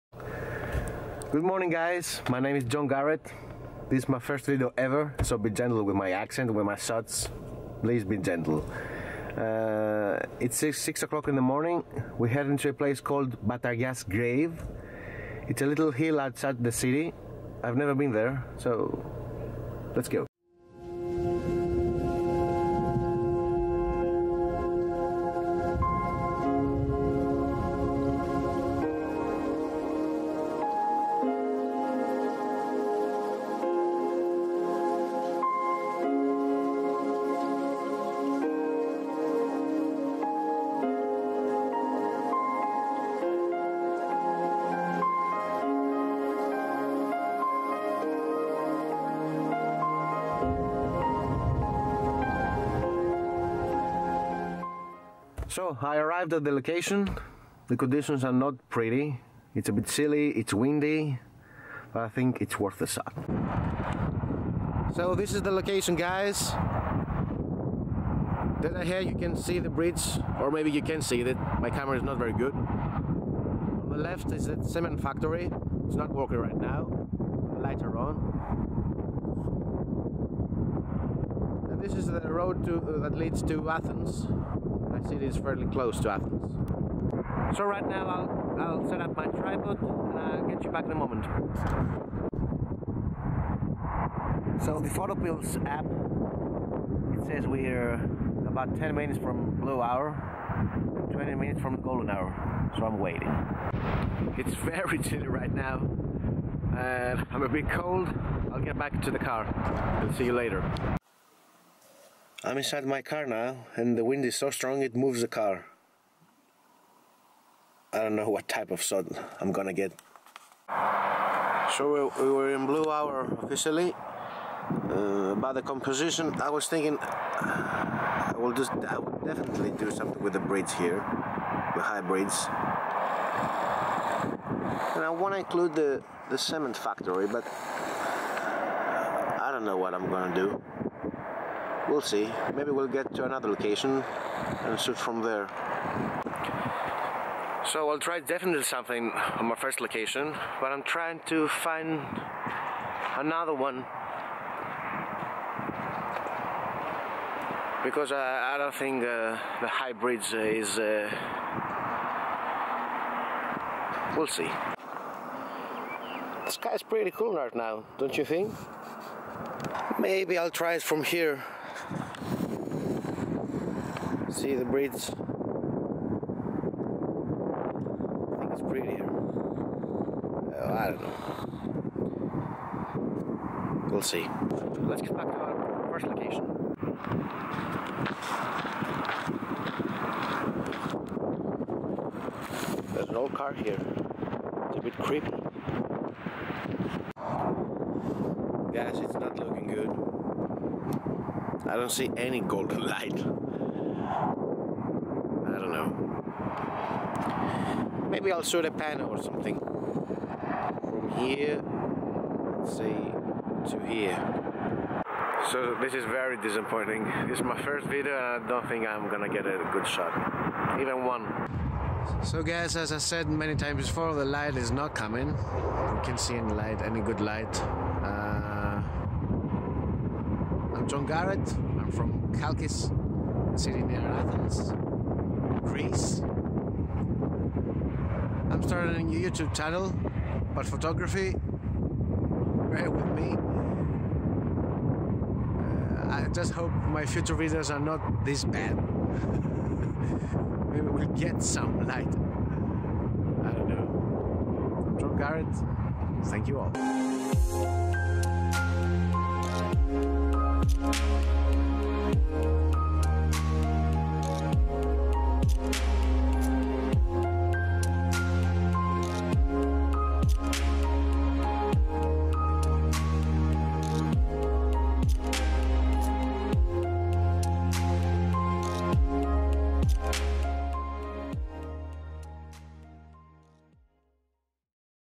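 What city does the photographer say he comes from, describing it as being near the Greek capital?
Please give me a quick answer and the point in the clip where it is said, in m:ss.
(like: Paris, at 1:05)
Chalkis, at 3:52.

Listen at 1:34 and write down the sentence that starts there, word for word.
So the Photopills app, it says we're about 10 minutes from blue hour, 20 minutes from golden hour, so I'm waiting.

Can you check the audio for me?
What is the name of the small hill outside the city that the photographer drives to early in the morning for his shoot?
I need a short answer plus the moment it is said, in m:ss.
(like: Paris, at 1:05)
Batarias Grave, at 0:13.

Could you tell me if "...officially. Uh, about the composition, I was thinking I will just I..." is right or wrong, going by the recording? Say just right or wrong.
right.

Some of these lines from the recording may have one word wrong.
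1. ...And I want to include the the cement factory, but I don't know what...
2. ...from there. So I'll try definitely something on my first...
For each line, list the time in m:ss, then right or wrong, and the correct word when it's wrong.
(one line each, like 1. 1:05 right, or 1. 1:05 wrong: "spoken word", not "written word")
1. 2:14 right
2. 2:24 right.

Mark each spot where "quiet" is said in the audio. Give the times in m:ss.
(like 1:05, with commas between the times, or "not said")
not said.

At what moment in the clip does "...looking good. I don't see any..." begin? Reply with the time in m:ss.
3:19.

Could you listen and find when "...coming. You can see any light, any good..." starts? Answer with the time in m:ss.
3:44.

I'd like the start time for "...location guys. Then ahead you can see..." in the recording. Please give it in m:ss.
1:05.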